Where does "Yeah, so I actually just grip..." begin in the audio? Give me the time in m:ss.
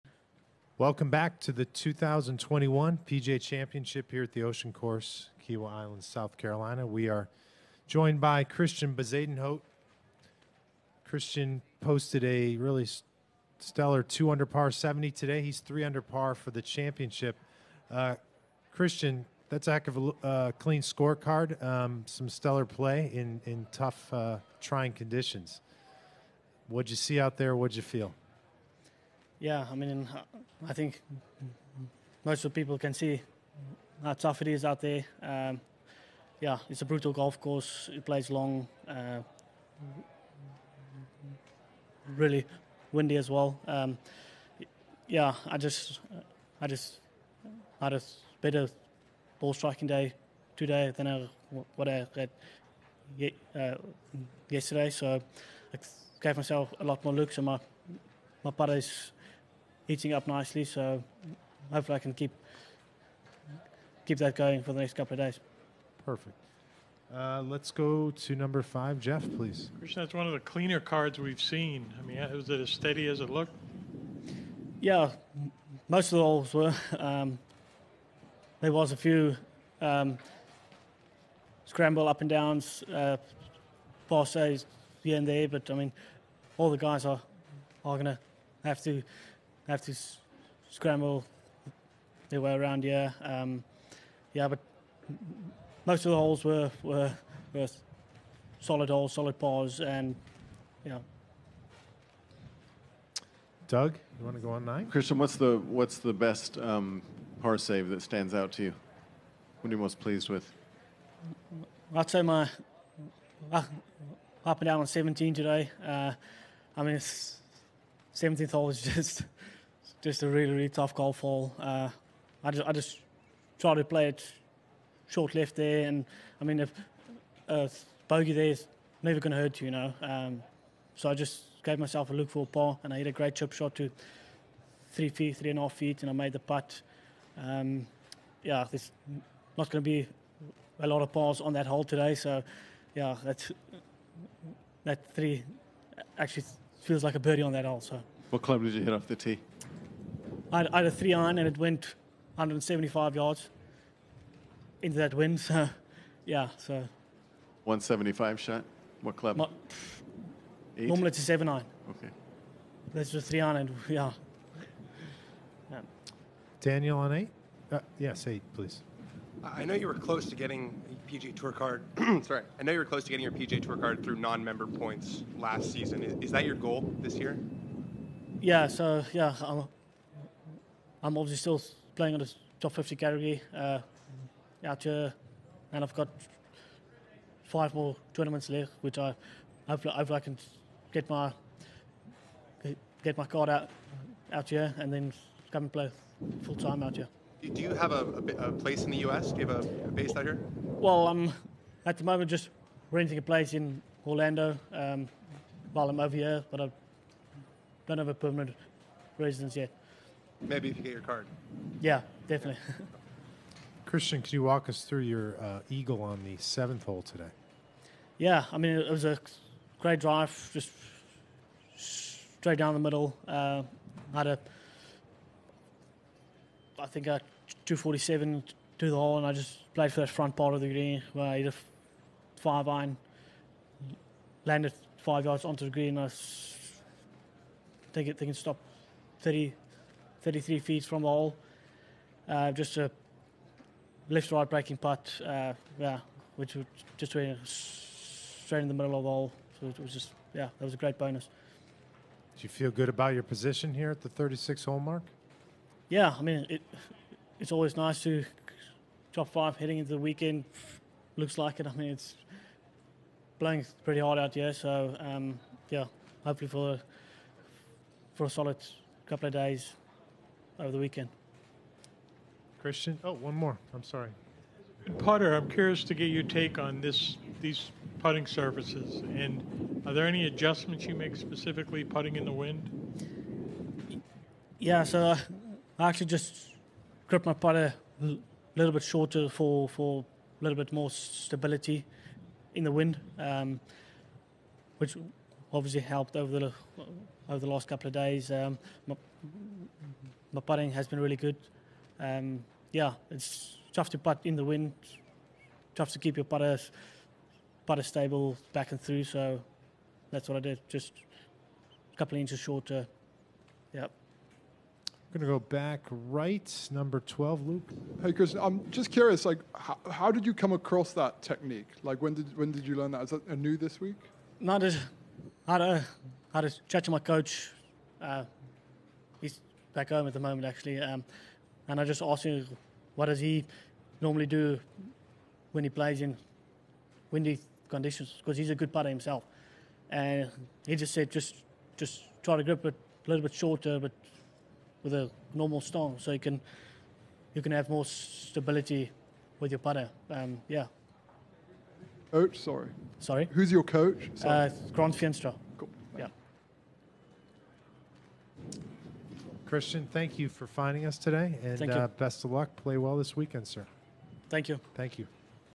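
4:44.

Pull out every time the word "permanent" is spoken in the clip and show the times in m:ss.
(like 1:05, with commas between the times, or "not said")
3:28.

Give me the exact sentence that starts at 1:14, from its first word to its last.
Yeah, most of the holes were.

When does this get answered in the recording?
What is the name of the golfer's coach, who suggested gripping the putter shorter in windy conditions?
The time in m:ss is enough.
5:54.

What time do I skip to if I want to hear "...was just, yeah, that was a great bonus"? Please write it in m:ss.
4:09.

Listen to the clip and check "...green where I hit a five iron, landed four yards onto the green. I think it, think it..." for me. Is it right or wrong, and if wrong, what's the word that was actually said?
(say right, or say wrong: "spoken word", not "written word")
wrong: "five", not "four".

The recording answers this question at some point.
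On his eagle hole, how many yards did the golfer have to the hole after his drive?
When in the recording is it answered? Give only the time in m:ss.
3:47.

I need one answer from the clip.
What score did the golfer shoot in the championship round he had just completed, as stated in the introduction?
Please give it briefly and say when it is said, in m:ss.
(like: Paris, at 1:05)
70, at 0:14.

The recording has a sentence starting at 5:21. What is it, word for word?
Like, when did, when did you learn that?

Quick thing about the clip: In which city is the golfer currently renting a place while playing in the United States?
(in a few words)
Orlando.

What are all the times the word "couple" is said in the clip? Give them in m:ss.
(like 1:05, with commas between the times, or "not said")
1:04, 4:29, 4:57, 5:11.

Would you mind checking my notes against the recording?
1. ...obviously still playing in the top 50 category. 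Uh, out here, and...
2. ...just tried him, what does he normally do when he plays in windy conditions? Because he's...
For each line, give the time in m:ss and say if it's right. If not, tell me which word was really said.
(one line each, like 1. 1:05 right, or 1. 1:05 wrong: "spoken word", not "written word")
1. 3:01 right
2. 5:31 wrong: "asked", not "tried".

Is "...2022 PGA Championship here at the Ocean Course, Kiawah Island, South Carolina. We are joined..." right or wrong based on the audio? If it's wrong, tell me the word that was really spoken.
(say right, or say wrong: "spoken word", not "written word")
wrong: "2021", not "2022".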